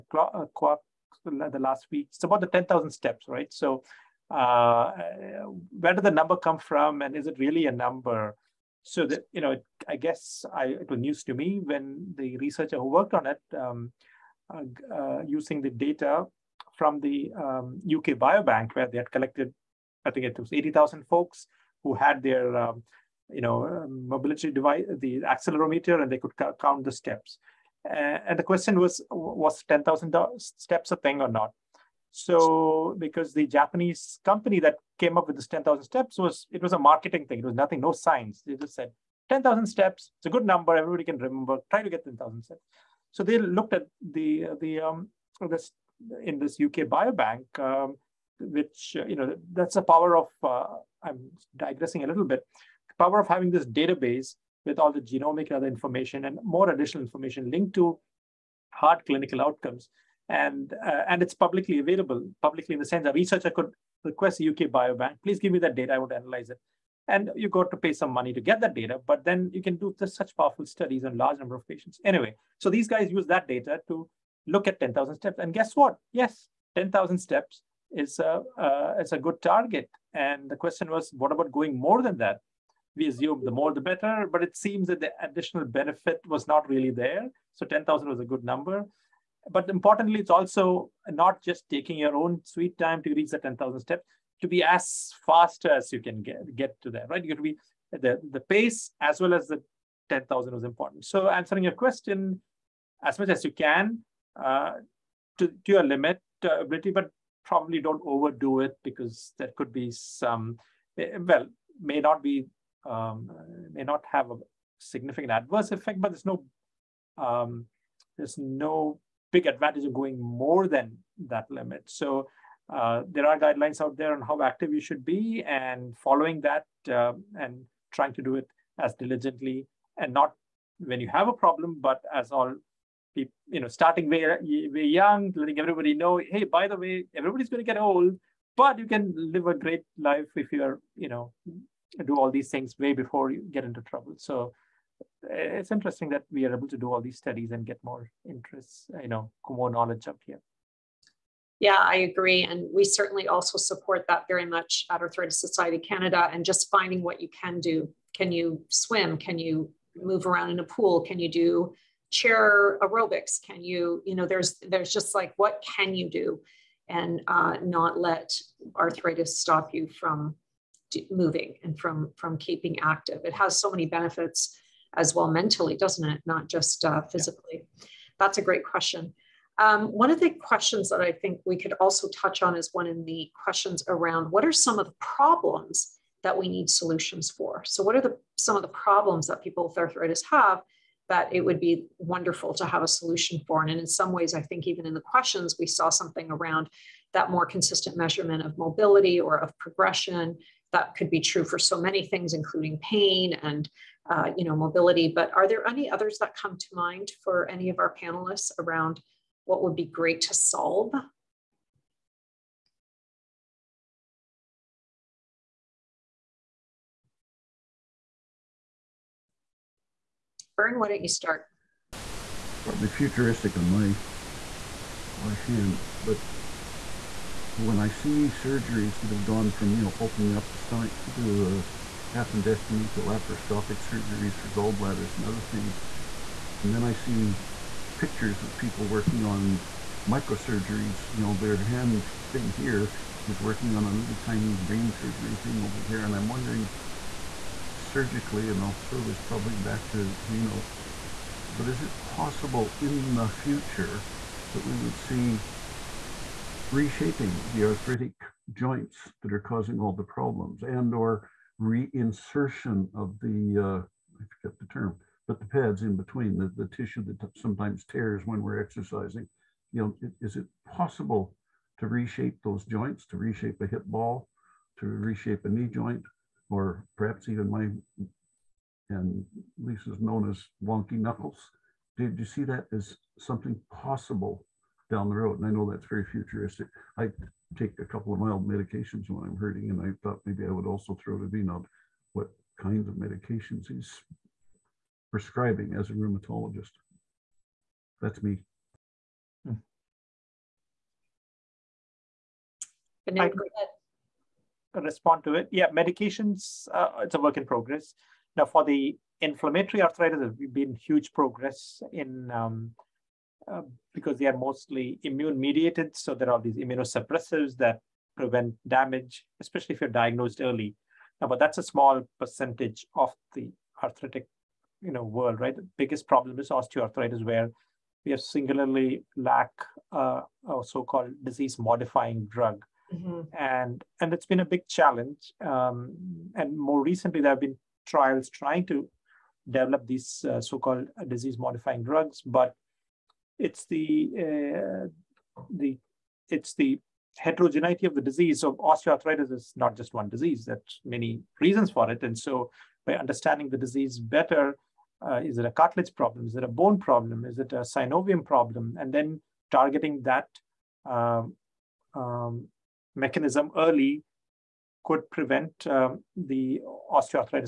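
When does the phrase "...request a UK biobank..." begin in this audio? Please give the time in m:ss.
1:04.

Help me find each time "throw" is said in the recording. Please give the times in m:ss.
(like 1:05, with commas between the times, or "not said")
4:08, 4:51.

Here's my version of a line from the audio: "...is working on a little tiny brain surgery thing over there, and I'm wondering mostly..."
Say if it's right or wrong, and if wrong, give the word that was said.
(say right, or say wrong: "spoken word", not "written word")
wrong: "surgically", not "mostly".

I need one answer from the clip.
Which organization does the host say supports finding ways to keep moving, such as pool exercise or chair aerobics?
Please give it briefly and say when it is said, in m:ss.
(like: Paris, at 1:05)
Arthritis Society Canada, at 2:35.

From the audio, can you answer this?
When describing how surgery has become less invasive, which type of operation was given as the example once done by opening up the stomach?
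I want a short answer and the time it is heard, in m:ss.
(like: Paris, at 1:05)
appendectomy, at 3:52.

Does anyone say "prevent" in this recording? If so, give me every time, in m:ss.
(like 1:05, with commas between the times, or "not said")
5:18, 6:05.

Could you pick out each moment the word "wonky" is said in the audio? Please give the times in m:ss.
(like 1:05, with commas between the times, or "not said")
4:40.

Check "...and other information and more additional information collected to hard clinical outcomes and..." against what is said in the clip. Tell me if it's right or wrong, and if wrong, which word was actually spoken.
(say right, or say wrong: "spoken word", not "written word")
wrong: "linked", not "collected".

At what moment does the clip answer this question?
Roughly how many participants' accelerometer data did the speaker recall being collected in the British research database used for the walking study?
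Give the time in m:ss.
0:20.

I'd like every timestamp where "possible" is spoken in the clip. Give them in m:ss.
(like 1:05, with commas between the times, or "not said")
4:12, 4:30, 4:43.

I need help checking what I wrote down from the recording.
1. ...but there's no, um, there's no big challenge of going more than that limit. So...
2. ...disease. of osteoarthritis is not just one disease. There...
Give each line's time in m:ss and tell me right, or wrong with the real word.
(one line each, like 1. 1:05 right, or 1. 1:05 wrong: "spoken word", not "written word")
1. 1:55 wrong: "advantage", not "challenge"
2. 5:48 right.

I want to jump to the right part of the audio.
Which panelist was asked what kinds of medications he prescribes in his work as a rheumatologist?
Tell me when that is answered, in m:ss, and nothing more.
4:51.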